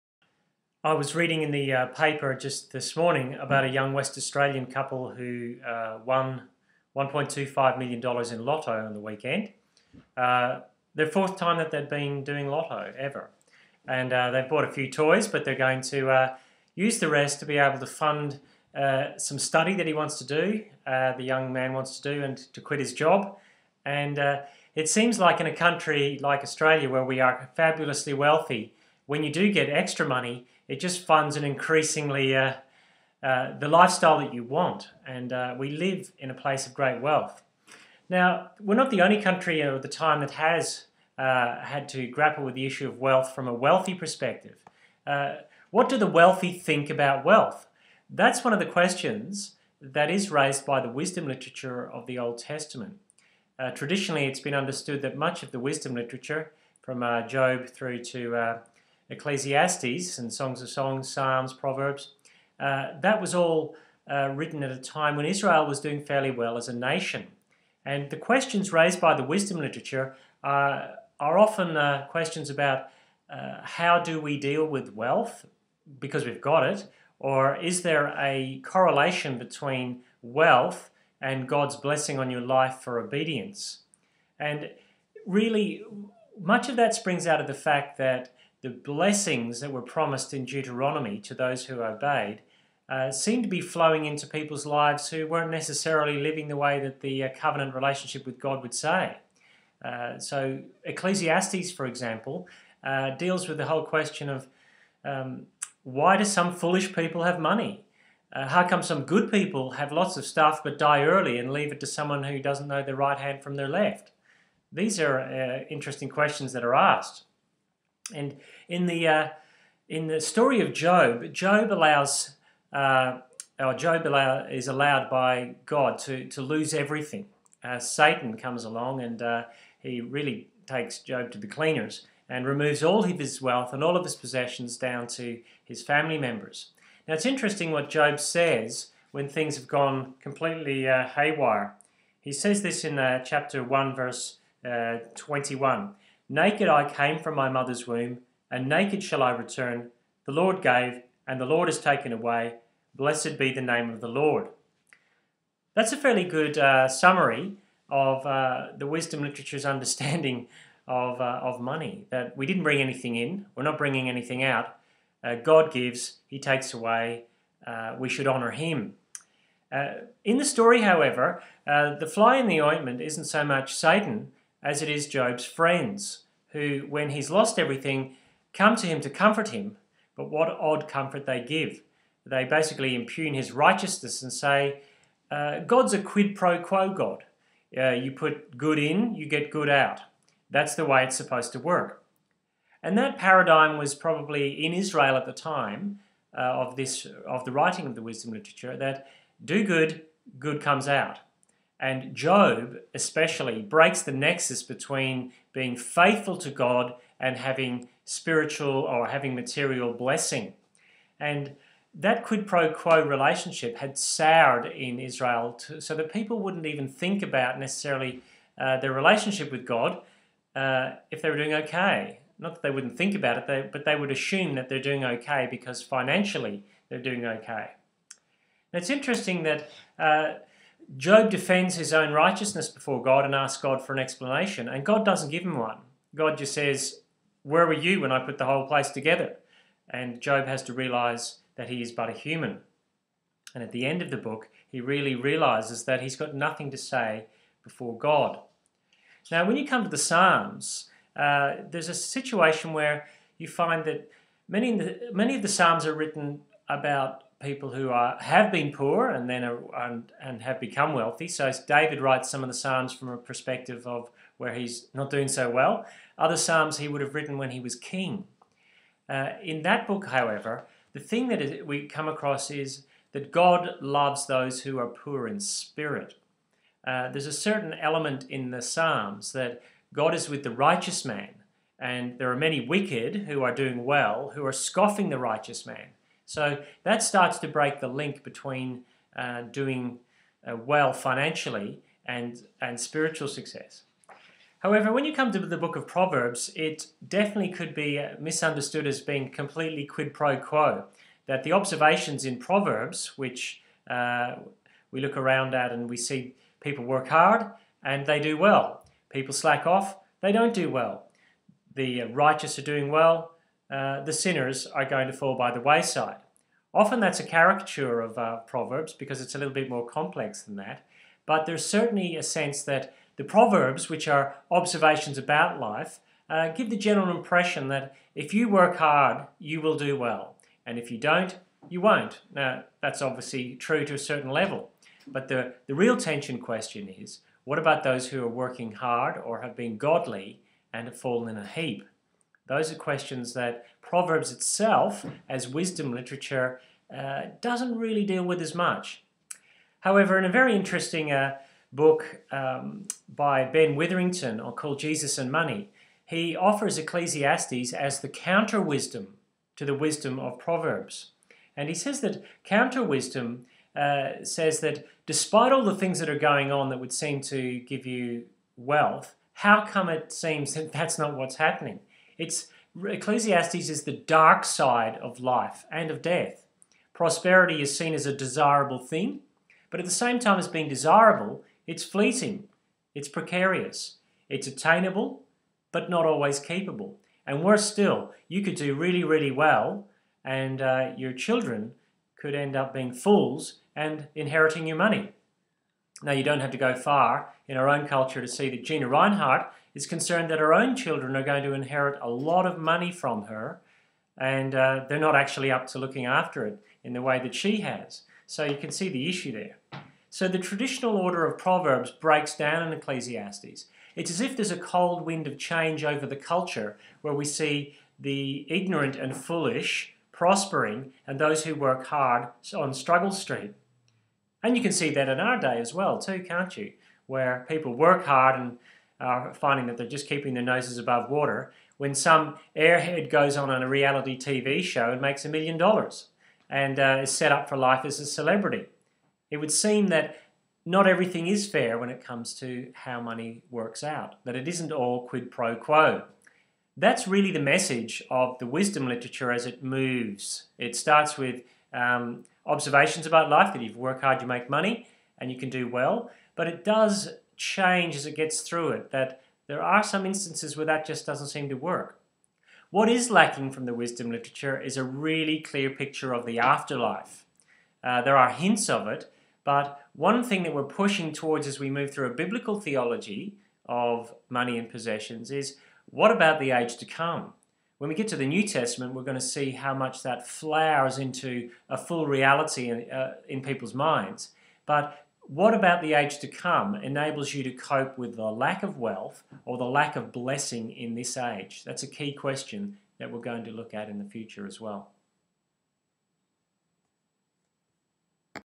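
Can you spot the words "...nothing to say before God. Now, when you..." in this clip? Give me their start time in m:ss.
4:06.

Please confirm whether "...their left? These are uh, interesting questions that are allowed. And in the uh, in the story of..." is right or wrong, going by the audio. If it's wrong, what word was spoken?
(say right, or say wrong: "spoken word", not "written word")
wrong: "asked", not "allowed".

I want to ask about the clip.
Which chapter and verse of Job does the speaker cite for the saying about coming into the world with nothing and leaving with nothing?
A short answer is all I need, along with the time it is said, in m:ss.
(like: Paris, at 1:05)
Chapter 1, verse 21, at 2:23.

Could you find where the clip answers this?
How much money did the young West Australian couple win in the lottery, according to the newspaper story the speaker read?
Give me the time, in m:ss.
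0:06.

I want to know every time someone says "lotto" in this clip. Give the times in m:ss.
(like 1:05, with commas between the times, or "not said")
0:08, 0:12.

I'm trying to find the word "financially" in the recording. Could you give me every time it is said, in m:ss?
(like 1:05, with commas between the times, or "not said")
3:45, 4:50.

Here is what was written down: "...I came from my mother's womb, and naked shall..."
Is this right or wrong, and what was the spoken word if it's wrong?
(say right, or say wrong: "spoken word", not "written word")
right.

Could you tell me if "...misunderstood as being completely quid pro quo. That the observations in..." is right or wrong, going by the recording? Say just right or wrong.
right.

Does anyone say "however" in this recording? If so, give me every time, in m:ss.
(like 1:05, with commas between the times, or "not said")
2:50, 4:30, 4:54, 5:49.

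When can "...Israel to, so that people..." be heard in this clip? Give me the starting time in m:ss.
3:34.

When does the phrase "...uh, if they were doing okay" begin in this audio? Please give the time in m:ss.
3:40.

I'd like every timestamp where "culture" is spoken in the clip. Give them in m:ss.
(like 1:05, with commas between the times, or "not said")
6:37, 6:56.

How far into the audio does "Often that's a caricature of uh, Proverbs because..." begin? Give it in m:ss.
5:16.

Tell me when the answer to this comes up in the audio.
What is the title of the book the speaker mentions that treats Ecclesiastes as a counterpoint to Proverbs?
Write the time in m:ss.
5:54.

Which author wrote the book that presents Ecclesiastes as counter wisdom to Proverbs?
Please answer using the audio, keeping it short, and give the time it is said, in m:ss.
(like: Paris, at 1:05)
Ben Witherington, at 5:53.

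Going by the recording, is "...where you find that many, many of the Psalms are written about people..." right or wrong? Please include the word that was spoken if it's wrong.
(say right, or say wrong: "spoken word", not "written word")
right.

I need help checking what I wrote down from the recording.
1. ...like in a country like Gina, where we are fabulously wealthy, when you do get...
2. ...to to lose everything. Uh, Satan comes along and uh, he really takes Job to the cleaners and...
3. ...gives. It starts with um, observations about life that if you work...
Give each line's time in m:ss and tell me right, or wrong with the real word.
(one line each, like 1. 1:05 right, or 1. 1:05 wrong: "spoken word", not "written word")
1. 0:25 wrong: "Australia", not "Gina"
2. 2:05 right
3. 7:29 wrong: "moves", not "gives".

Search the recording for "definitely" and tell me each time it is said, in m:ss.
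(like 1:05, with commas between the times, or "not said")
4:57.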